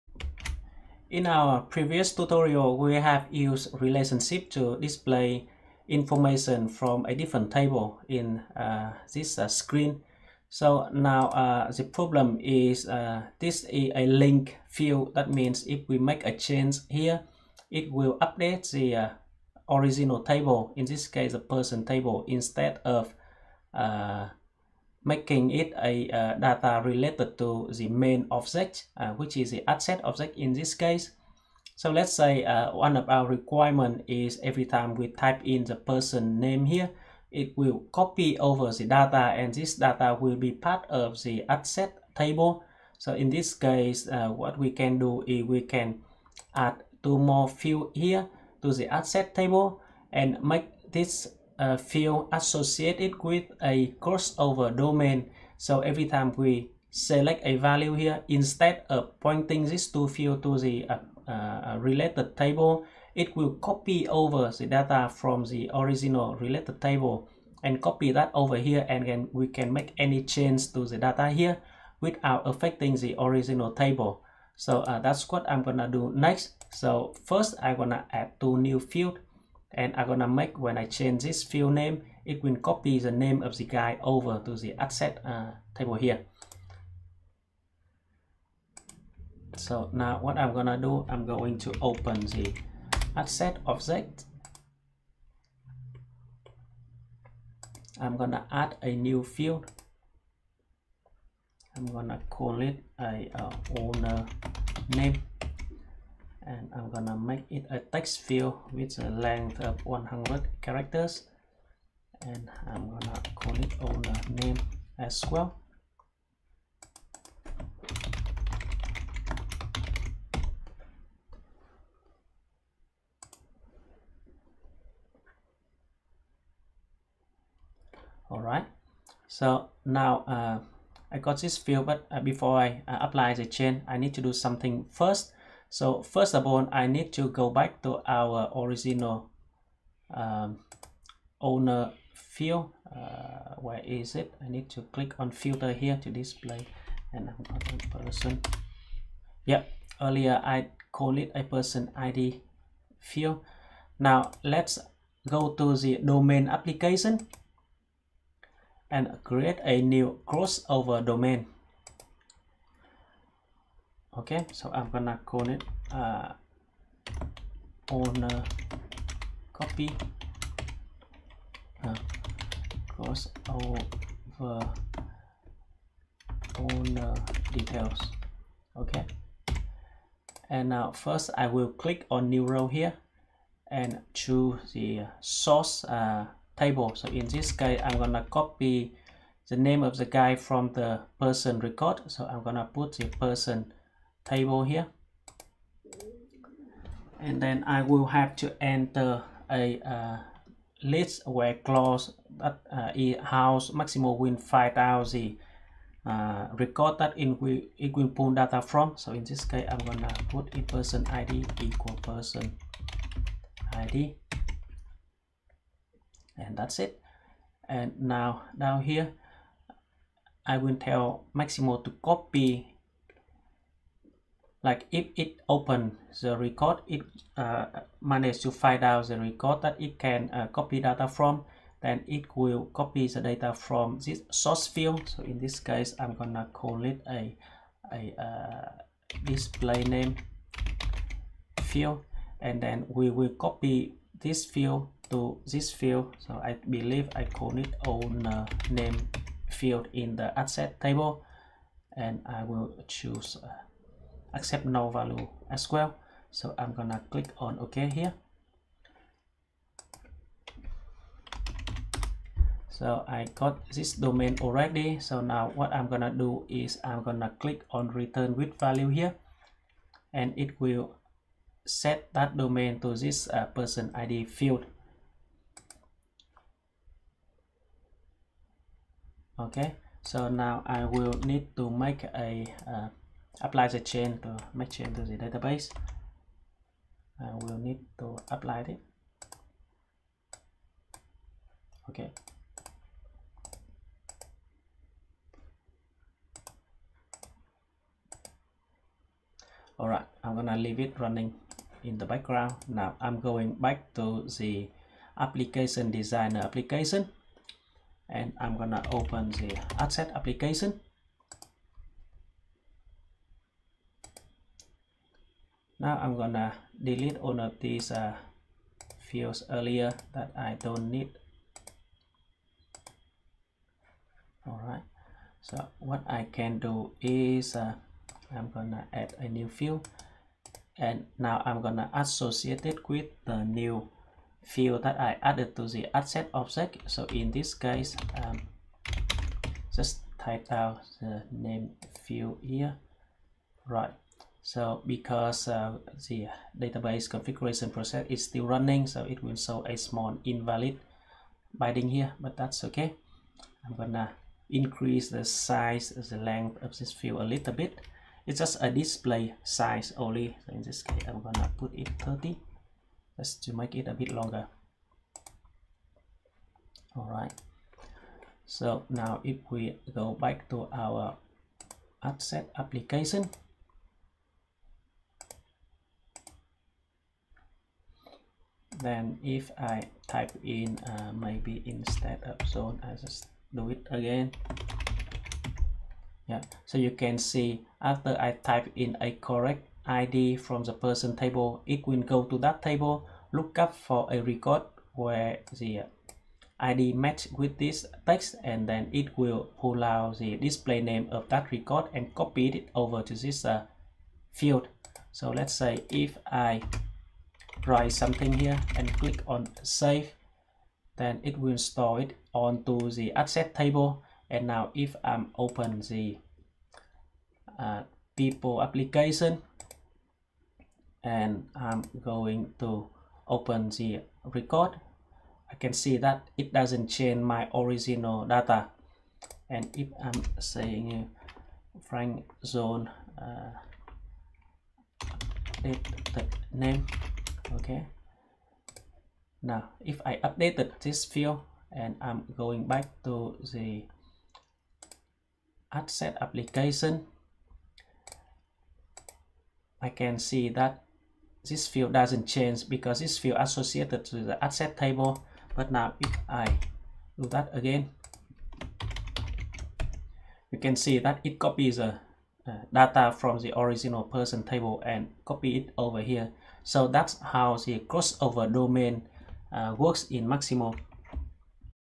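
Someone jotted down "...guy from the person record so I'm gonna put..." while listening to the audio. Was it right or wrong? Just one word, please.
right.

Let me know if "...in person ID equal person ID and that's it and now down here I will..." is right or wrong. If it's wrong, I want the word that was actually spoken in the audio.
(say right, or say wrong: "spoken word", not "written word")
right.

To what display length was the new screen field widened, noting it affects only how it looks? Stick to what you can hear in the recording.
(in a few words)
30.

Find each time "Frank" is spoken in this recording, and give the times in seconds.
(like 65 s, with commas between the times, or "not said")
431 s.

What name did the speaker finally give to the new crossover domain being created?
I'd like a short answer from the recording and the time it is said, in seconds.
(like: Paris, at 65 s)
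cross over owner details, at 172 s.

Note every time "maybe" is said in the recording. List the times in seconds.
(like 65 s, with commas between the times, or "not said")
381 s.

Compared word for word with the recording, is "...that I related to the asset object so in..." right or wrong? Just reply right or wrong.
wrong.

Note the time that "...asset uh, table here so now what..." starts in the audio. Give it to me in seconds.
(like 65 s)
84 s.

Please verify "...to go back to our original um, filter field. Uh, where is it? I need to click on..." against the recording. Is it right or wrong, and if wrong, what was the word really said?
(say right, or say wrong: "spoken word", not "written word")
wrong: "owner", not "filter".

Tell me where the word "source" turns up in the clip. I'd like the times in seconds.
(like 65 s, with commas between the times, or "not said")
185 s, 234 s.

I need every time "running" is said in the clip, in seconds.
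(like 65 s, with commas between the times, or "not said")
300 s, 348 s.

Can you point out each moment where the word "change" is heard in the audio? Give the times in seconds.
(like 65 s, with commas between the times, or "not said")
16 s, 70 s, 80 s, 284 s, 426 s, 452 s.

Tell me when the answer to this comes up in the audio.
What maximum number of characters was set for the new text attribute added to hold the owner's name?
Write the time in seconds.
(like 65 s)
109 s.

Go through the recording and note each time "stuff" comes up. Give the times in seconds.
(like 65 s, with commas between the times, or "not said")
not said.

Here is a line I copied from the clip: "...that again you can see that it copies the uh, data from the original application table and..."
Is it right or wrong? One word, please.
wrong.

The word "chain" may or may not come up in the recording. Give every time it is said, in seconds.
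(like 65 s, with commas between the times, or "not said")
133 s, 283 s.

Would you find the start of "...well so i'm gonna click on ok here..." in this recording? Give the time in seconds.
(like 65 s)
255 s.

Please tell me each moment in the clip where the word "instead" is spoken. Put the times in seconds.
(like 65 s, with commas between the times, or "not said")
22 s, 58 s, 381 s.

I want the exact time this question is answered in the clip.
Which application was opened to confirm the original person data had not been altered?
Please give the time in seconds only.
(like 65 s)
418 s.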